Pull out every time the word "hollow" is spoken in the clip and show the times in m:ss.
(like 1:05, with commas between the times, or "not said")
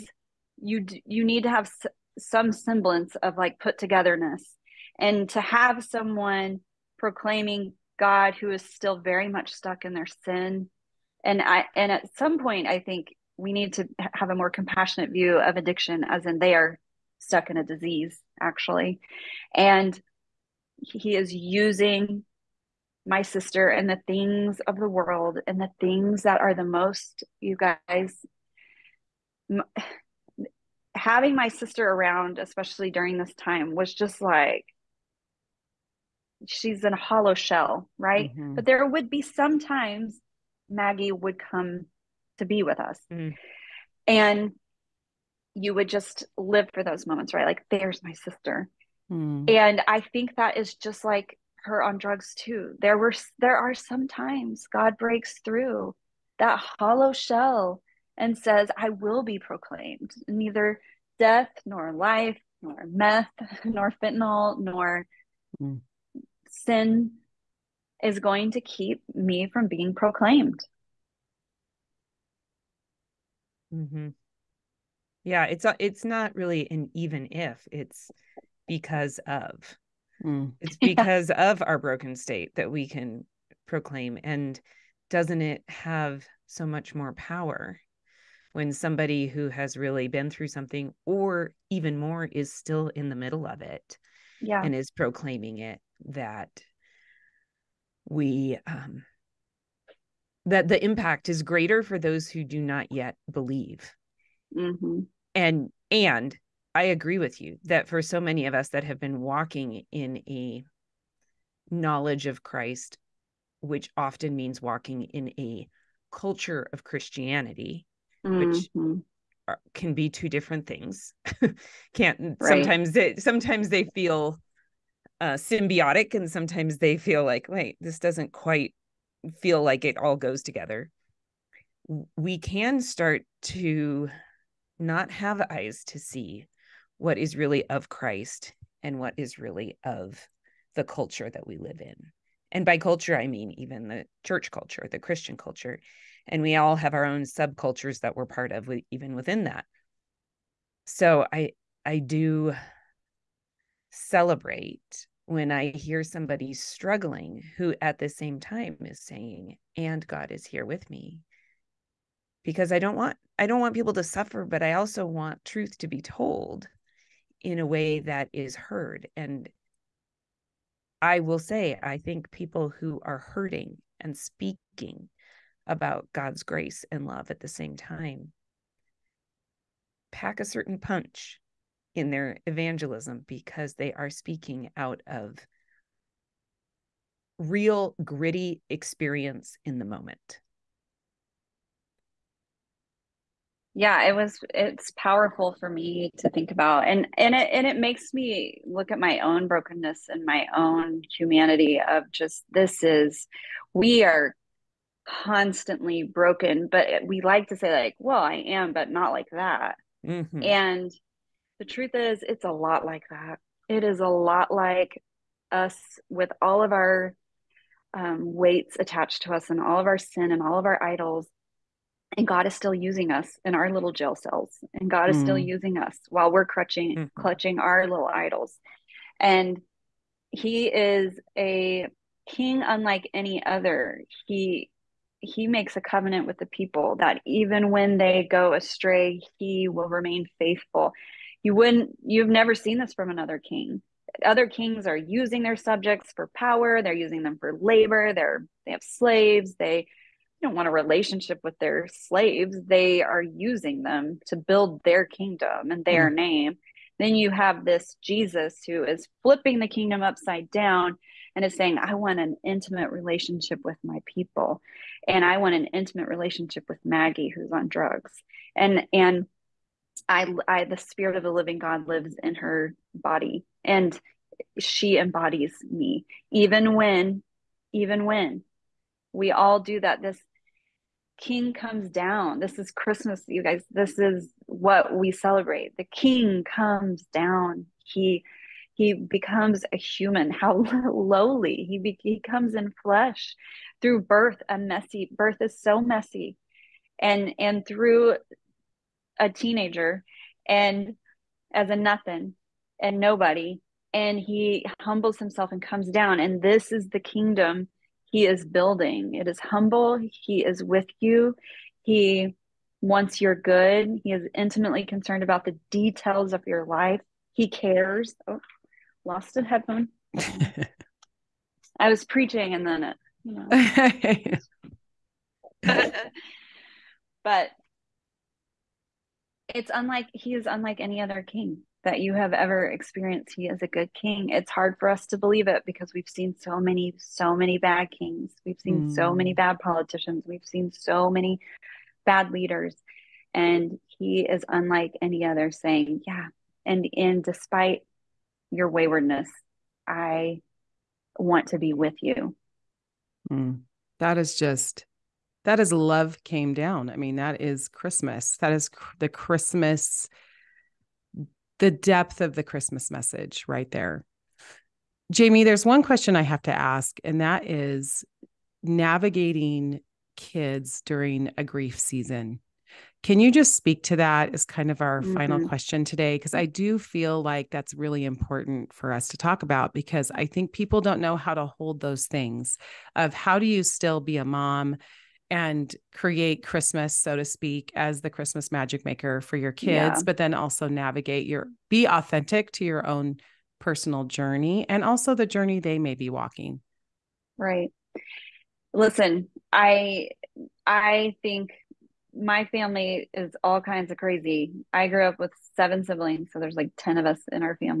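0:36, 0:56.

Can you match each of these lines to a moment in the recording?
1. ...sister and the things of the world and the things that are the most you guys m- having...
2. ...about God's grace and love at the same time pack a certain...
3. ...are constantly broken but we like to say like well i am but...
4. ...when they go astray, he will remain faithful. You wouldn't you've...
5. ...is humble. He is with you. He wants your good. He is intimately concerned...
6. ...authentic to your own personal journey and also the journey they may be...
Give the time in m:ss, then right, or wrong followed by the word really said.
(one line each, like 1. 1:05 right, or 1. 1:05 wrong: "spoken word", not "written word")
1. 0:23 right
2. 2:55 right
3. 3:24 right
4. 3:57 right
5. 5:09 right
6. 6:31 right.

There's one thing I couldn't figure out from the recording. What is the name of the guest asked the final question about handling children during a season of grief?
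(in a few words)
Jami.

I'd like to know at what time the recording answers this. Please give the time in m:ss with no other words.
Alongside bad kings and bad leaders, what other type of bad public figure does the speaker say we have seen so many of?
5:39.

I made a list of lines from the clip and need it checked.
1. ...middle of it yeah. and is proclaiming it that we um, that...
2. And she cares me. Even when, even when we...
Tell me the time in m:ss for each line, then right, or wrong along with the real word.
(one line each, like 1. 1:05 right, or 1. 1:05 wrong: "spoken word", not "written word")
1. 1:33 right
2. 4:33 wrong: "embodies", not "cares".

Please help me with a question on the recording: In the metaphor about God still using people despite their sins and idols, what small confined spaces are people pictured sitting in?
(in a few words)
jail cells.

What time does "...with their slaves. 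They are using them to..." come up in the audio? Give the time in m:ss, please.
4:11.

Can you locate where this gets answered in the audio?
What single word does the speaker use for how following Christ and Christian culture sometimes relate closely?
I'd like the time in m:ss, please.
2:05.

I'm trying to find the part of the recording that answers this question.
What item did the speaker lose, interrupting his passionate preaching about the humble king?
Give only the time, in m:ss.
5:19.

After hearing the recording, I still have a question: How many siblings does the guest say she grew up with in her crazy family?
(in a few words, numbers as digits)
7.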